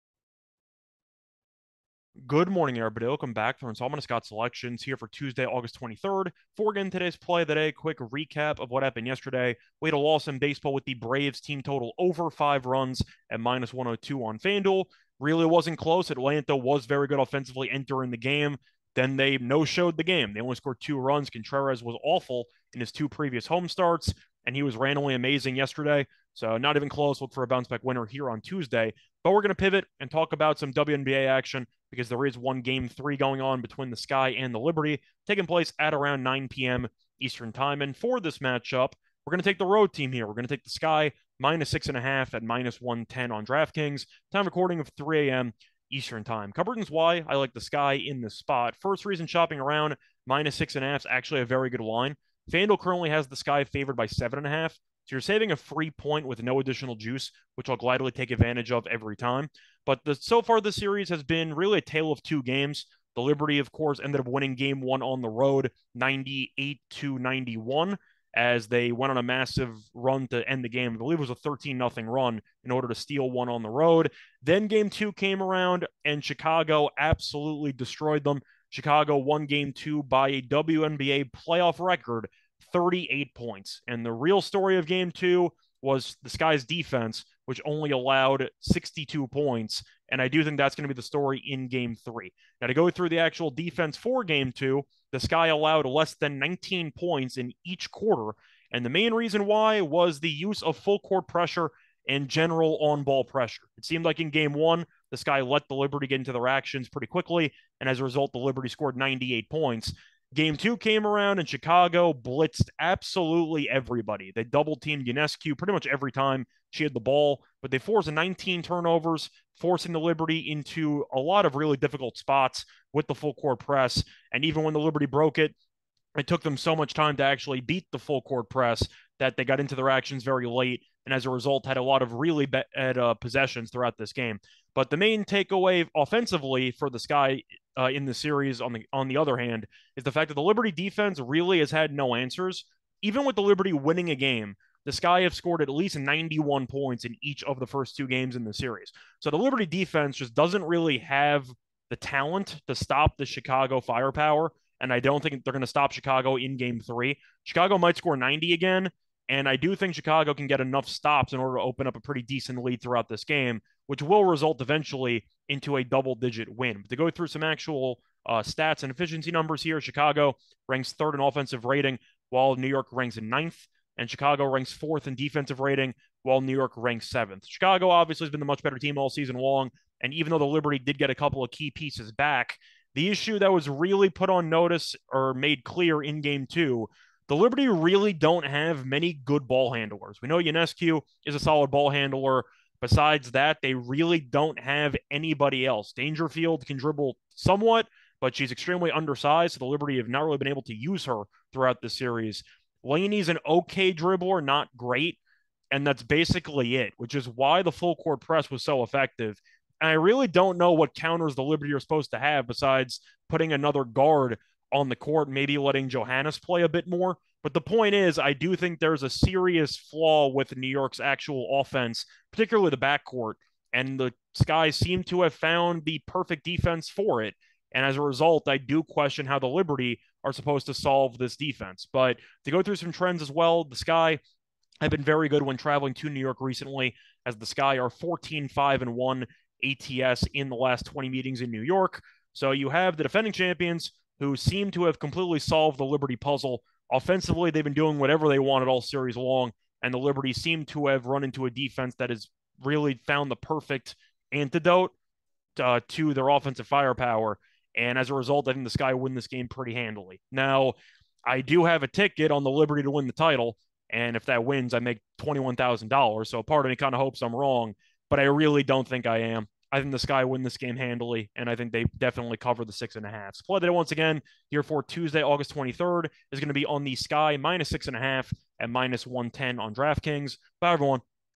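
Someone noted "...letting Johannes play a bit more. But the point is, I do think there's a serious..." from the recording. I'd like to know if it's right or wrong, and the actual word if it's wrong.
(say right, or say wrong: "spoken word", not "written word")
right.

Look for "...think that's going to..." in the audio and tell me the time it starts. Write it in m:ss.
1:30.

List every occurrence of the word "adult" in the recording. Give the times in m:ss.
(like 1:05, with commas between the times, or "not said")
not said.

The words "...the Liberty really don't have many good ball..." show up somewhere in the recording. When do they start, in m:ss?
3:07.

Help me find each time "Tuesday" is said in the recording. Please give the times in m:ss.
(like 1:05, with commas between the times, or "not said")
0:05, 0:28, 4:34.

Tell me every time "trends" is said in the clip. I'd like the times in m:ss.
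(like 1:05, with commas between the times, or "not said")
3:52.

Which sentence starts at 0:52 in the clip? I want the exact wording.
FanDuel currently has the sky favored by seven and a half.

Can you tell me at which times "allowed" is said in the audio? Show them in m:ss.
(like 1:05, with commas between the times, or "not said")
1:27, 1:35.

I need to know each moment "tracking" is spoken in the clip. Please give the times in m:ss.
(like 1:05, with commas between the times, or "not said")
not said.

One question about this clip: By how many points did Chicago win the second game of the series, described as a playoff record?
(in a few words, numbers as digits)
38.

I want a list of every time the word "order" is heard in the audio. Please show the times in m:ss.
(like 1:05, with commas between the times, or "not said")
1:12, 2:41.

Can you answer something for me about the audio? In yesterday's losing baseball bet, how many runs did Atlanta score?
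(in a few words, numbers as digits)
2.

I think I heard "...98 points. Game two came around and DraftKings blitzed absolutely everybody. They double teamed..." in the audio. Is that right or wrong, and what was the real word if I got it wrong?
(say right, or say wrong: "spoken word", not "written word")
wrong: "Chicago", not "DraftKings".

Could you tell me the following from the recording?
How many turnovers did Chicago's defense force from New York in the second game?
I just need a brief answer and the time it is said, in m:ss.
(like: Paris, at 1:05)
19, at 1:58.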